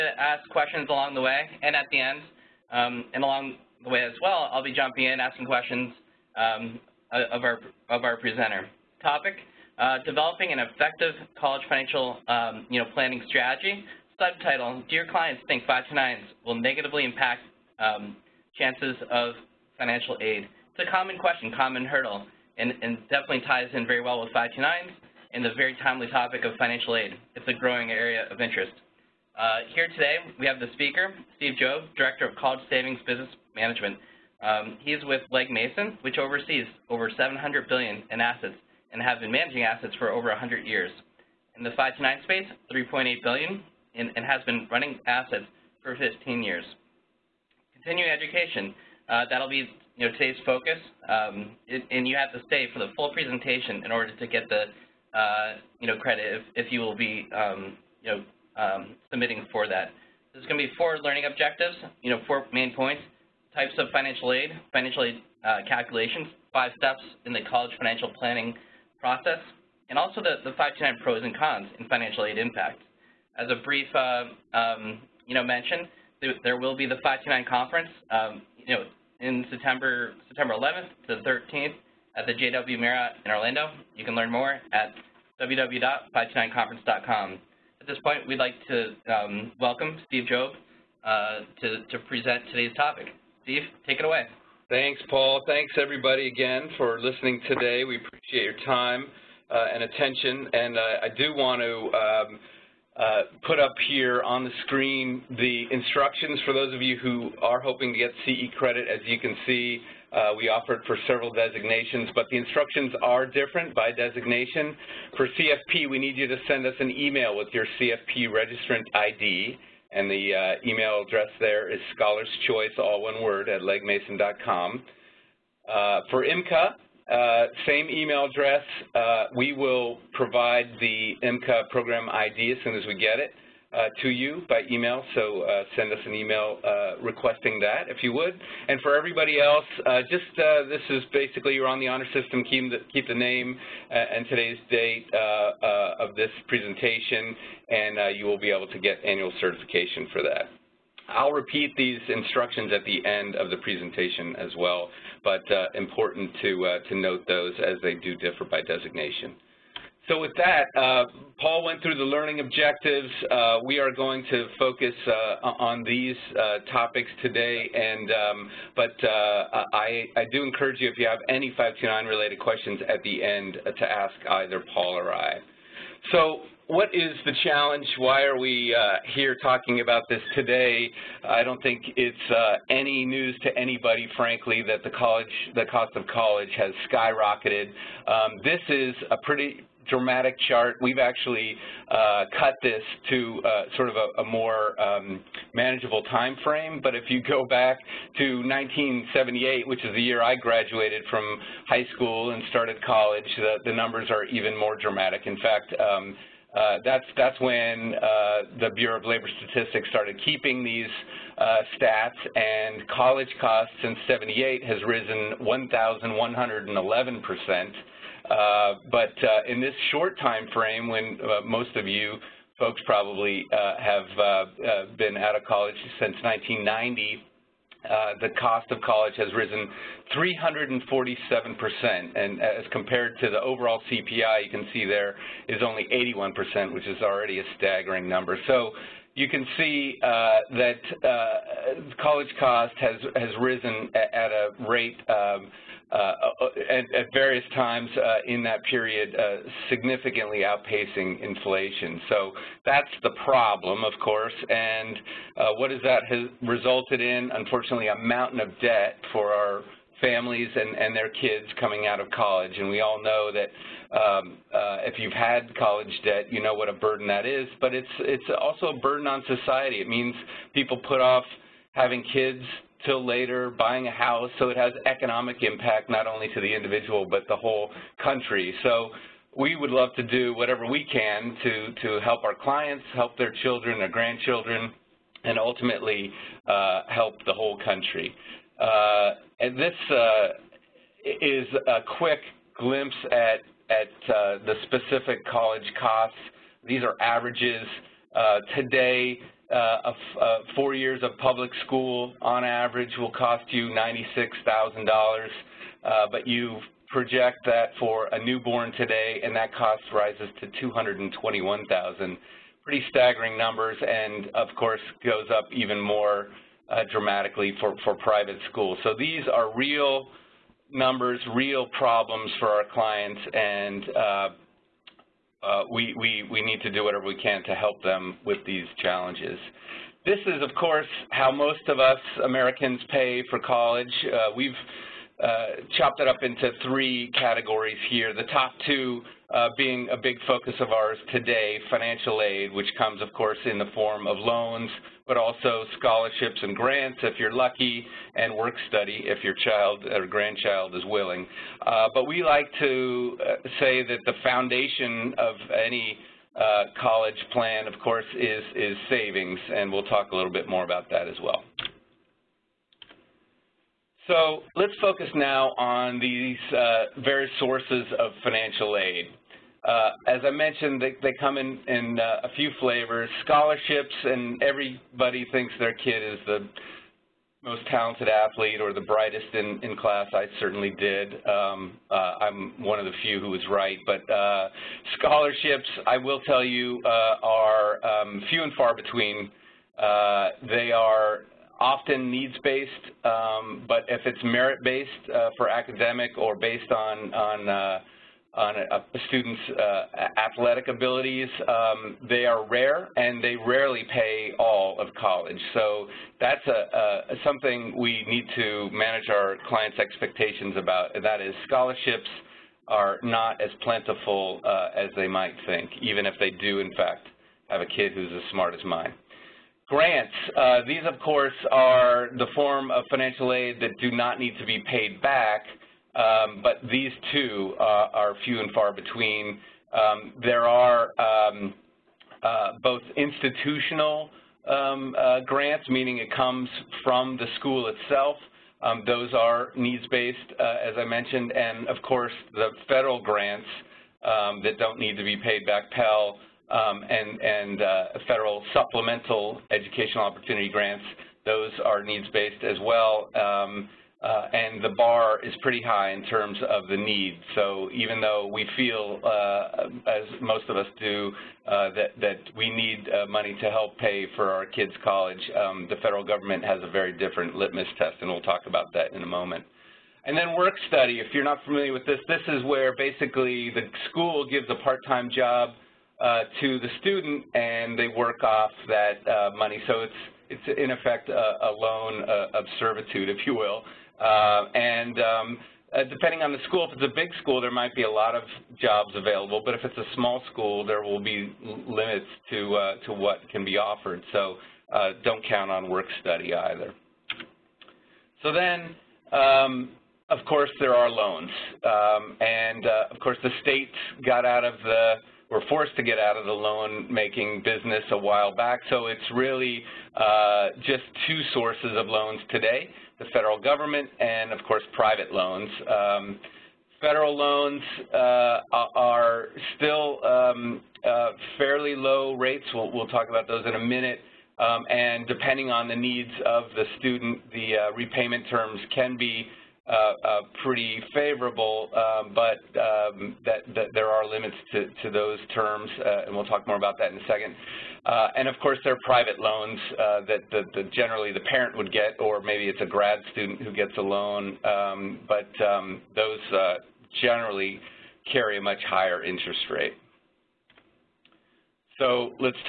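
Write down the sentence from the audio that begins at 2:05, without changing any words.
Uh, for IMCA, uh, same email address.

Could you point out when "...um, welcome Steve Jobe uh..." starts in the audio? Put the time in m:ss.
1:29.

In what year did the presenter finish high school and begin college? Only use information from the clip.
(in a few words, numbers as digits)
1978.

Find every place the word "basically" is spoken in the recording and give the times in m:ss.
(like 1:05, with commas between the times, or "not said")
2:21, 7:52.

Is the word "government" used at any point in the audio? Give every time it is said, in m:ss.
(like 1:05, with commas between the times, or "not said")
7:46, 8:33.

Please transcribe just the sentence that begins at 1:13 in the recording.
As a brief, uh, um, you know, mention, there, will be the 529 conference.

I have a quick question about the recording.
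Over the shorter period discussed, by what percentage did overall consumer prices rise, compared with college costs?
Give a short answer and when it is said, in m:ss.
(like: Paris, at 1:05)
81%, at 3:55.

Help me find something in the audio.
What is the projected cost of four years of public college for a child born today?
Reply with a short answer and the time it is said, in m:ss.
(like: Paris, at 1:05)
$221,000, at 5:10.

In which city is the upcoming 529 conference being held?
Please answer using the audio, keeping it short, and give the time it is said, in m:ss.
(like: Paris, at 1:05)
Orlando, at 1:23.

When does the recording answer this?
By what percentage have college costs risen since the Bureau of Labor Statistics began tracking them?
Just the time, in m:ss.
3:35.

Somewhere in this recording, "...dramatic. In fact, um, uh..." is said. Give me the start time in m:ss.
3:24.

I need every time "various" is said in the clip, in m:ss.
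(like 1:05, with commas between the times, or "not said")
4:07, 6:07.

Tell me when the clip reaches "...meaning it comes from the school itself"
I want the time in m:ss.
7:15.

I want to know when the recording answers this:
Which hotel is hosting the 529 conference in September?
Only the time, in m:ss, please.
1:22.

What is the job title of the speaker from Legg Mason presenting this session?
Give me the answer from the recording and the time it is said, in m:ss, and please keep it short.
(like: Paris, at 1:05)
Director of College Savings Business Management, at 0:31.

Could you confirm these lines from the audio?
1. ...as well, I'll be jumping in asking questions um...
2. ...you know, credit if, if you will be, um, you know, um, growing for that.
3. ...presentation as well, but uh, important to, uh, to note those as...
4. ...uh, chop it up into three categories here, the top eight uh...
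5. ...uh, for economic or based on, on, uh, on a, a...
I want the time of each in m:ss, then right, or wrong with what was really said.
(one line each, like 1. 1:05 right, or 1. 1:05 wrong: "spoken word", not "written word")
1. 0:04 right
2. 0:55 wrong: "submitting", not "growing"
3. 2:33 right
4. 5:35 wrong: "two", not "eight"
5. 6:35 wrong: "academic", not "economic".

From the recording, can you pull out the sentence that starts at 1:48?
As you can see, uh, we offered for several designations, but the instructions are different by designation.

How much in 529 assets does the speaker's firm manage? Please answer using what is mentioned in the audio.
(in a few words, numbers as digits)
3.8 billion.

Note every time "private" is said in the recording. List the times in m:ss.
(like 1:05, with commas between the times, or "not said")
5:17, 8:34, 8:58.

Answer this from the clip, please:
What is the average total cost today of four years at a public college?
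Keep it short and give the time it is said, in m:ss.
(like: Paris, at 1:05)
$96,000, at 5:03.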